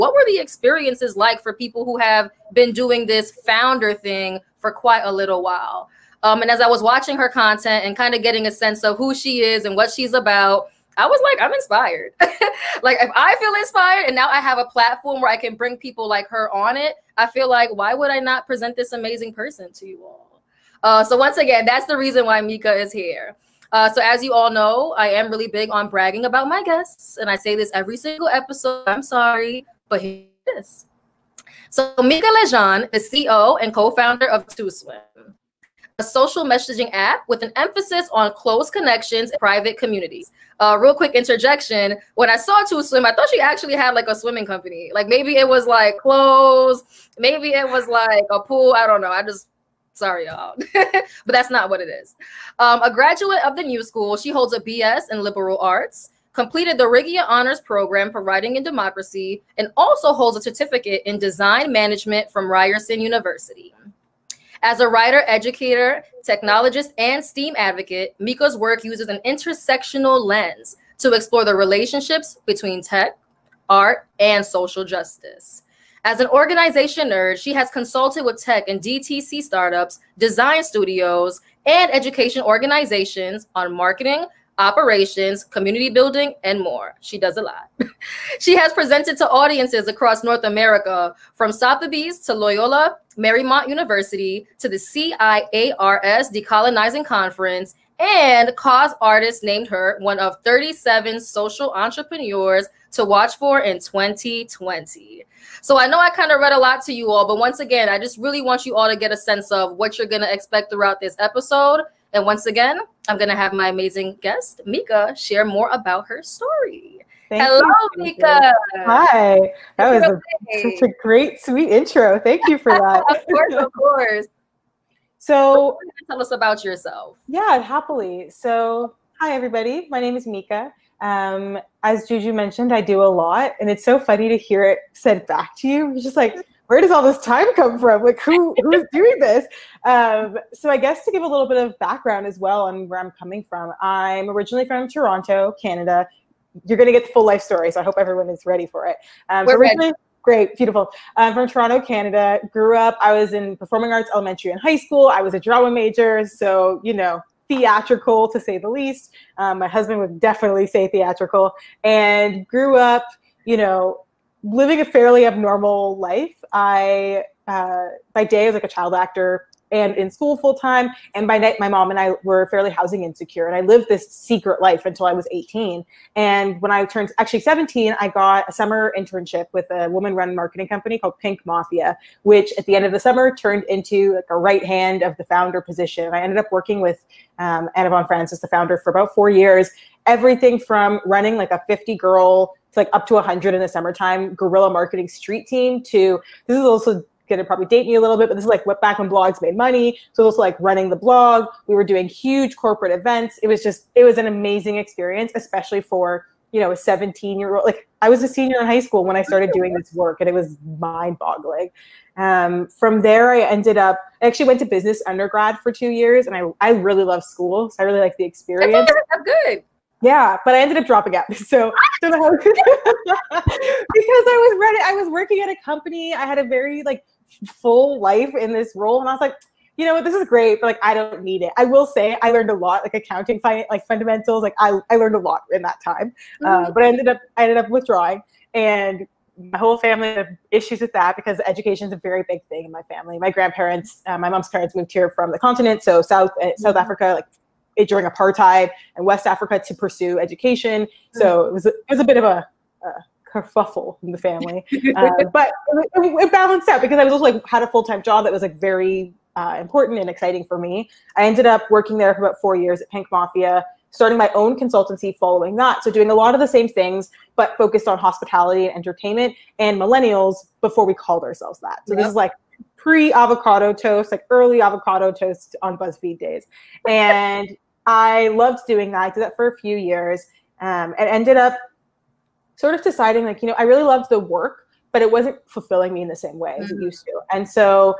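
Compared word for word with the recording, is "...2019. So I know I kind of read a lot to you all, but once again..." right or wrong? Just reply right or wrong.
wrong.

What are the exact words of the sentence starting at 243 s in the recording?
My grandparents, uh, my mom's parents moved here from the continent, so South uh, South mm-hmm.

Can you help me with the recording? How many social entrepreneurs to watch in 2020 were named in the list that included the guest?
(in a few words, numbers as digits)
37.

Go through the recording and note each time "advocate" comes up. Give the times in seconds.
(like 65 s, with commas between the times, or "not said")
67 s.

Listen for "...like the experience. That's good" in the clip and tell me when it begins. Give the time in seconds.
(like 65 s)
217 s.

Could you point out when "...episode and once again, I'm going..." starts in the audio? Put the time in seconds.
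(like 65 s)
111 s.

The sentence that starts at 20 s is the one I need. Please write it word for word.
Uh, so once again, that's the reason why Mica is here.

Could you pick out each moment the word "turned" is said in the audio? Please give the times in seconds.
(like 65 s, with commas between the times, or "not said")
176 s, 183 s.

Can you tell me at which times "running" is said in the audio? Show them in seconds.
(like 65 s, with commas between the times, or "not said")
191 s, 200 s.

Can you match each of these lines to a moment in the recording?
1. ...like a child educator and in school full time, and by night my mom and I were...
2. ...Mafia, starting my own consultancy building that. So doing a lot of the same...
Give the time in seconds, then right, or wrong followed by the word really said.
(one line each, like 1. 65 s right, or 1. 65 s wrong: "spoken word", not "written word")
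1. 168 s wrong: "actor", not "educator"
2. 263 s wrong: "following", not "building".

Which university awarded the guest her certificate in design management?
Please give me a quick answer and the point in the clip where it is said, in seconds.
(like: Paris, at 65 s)
Ryerson University, at 62 s.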